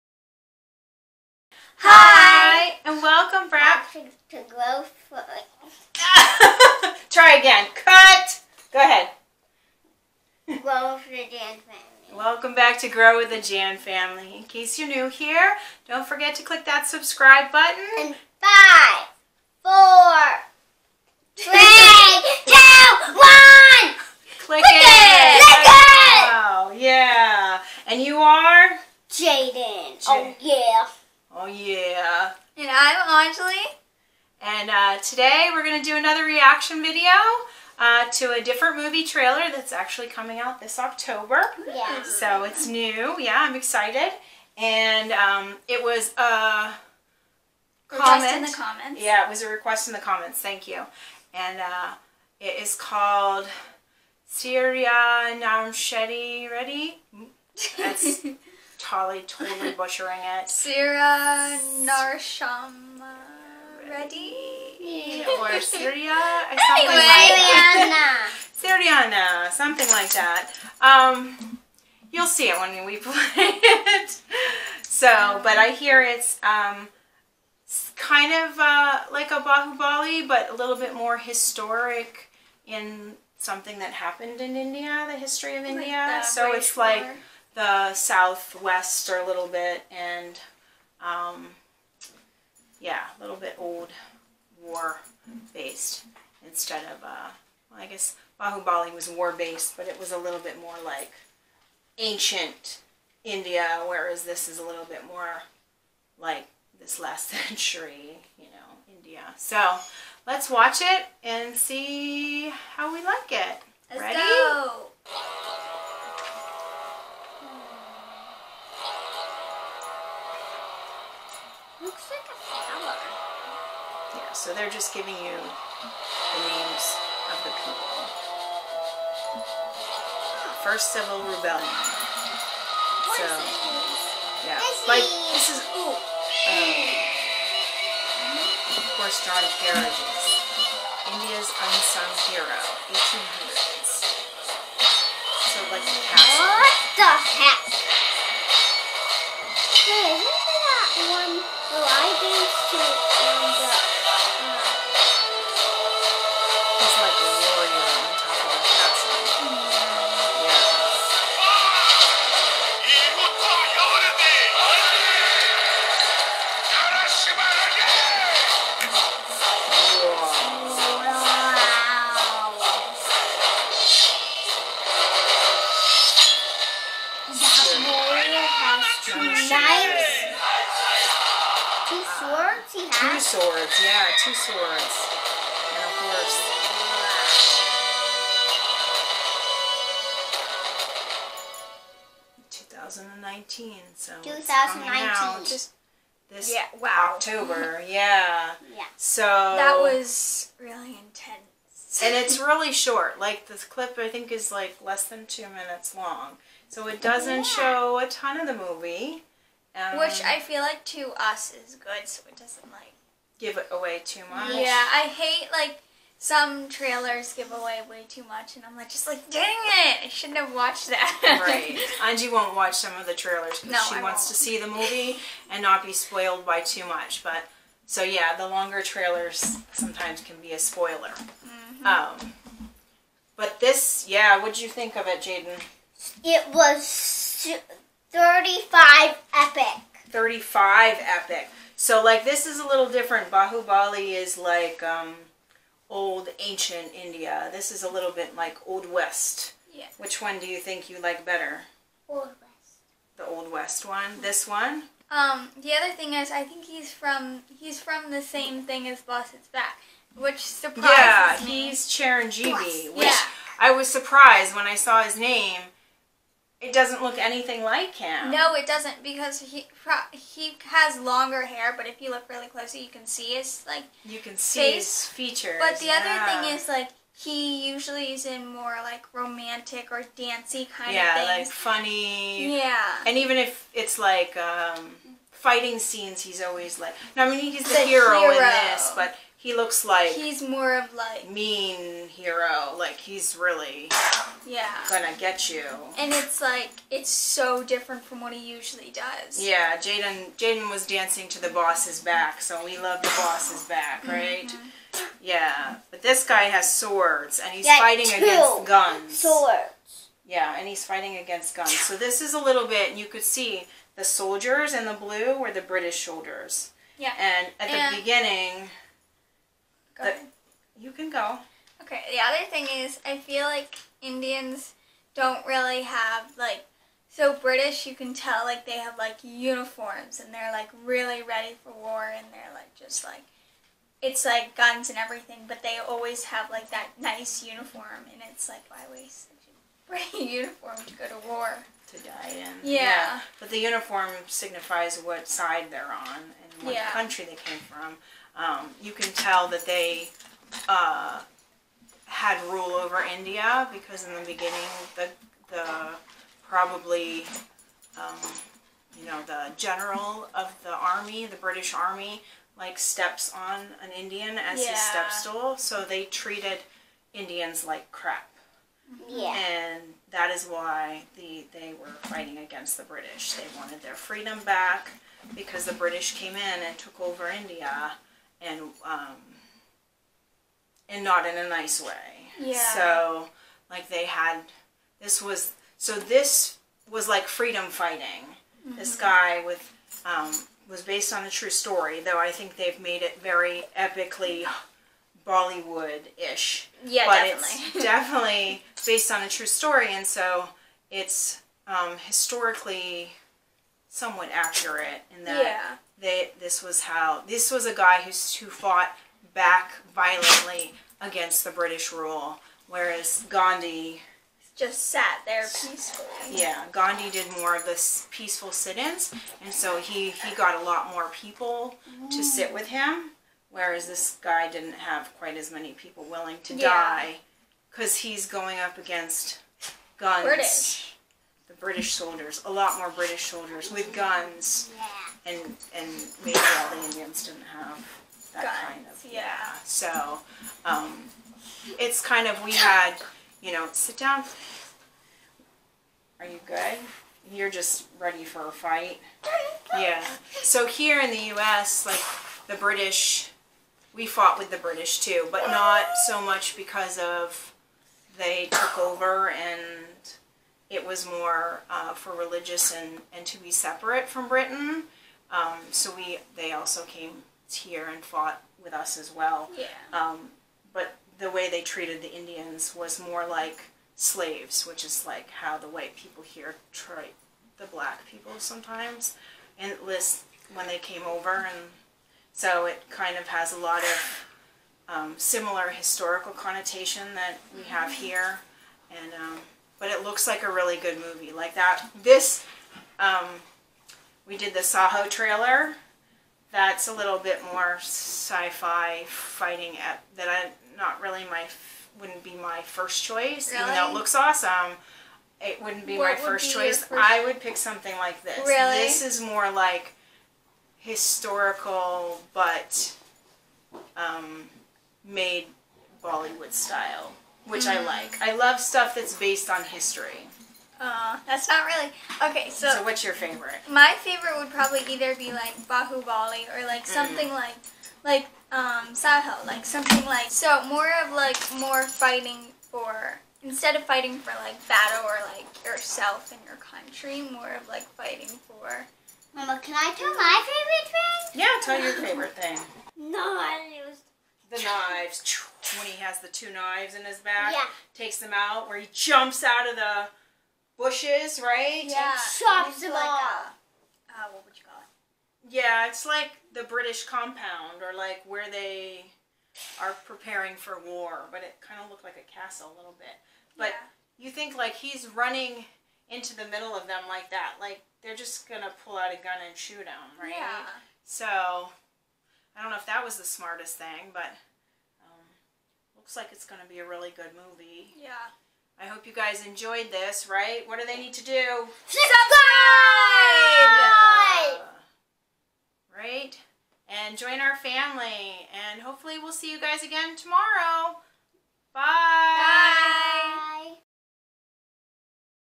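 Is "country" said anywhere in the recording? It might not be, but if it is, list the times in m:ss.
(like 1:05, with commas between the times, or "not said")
5:46, 8:56.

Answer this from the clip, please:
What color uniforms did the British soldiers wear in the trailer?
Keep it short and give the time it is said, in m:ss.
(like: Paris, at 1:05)
Blue, at 5:15.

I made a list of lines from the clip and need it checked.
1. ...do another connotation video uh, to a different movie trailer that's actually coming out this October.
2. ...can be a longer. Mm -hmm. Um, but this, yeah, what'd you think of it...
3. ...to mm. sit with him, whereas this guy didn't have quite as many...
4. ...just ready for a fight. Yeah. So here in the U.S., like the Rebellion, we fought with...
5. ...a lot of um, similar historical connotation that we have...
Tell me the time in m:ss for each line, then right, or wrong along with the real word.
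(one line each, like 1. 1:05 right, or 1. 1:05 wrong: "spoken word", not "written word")
1. 0:35 wrong: "reaction", not "connotation"
2. 3:50 wrong: "spoiler", not "longer"
3. 7:02 right
4. 7:27 wrong: "British", not "Rebellion"
5. 8:03 right.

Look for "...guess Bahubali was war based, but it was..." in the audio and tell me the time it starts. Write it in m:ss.
1:37.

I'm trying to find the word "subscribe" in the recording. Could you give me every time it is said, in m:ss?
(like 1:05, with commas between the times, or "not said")
0:16, 9:41.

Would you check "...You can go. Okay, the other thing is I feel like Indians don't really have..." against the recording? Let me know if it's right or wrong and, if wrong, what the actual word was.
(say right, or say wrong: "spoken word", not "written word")
right.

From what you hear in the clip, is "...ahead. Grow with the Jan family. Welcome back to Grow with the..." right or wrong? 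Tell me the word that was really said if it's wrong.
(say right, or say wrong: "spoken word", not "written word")
right.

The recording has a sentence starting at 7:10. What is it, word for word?
British the British soldiers, a lot more British soldiers with guns, yeah.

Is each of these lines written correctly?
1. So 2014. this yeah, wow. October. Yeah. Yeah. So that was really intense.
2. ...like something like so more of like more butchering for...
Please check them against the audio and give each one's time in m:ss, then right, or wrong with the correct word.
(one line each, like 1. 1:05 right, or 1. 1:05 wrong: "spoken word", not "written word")
1. 3:13 wrong: "2019", not "2014"
2. 8:49 wrong: "fighting", not "butchering".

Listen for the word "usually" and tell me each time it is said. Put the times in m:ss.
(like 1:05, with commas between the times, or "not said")
4:37, 4:58.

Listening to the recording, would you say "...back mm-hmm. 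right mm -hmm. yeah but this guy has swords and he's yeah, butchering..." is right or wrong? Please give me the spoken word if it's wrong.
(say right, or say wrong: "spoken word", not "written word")
wrong: "fighting", not "butchering".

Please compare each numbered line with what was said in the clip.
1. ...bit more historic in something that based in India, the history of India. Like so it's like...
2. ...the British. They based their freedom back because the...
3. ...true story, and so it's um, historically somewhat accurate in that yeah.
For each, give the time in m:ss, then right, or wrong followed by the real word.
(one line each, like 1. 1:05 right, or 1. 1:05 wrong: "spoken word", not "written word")
1. 1:20 wrong: "happened", not "based"
2. 6:12 wrong: "wanted", not "based"
3. 6:39 right.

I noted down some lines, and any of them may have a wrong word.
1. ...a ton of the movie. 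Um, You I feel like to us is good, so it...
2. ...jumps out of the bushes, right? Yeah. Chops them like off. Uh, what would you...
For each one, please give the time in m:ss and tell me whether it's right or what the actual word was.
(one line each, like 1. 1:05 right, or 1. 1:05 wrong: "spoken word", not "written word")
1. 3:27 wrong: "Which", not "You"
2. 9:08 right.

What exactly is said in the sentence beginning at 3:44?
to see the movie and not be spoiled by too much.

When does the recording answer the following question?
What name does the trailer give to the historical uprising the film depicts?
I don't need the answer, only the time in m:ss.
2:10.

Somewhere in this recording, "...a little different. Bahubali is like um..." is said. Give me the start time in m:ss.
4:02.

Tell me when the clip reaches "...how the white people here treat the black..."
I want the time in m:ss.
7:55.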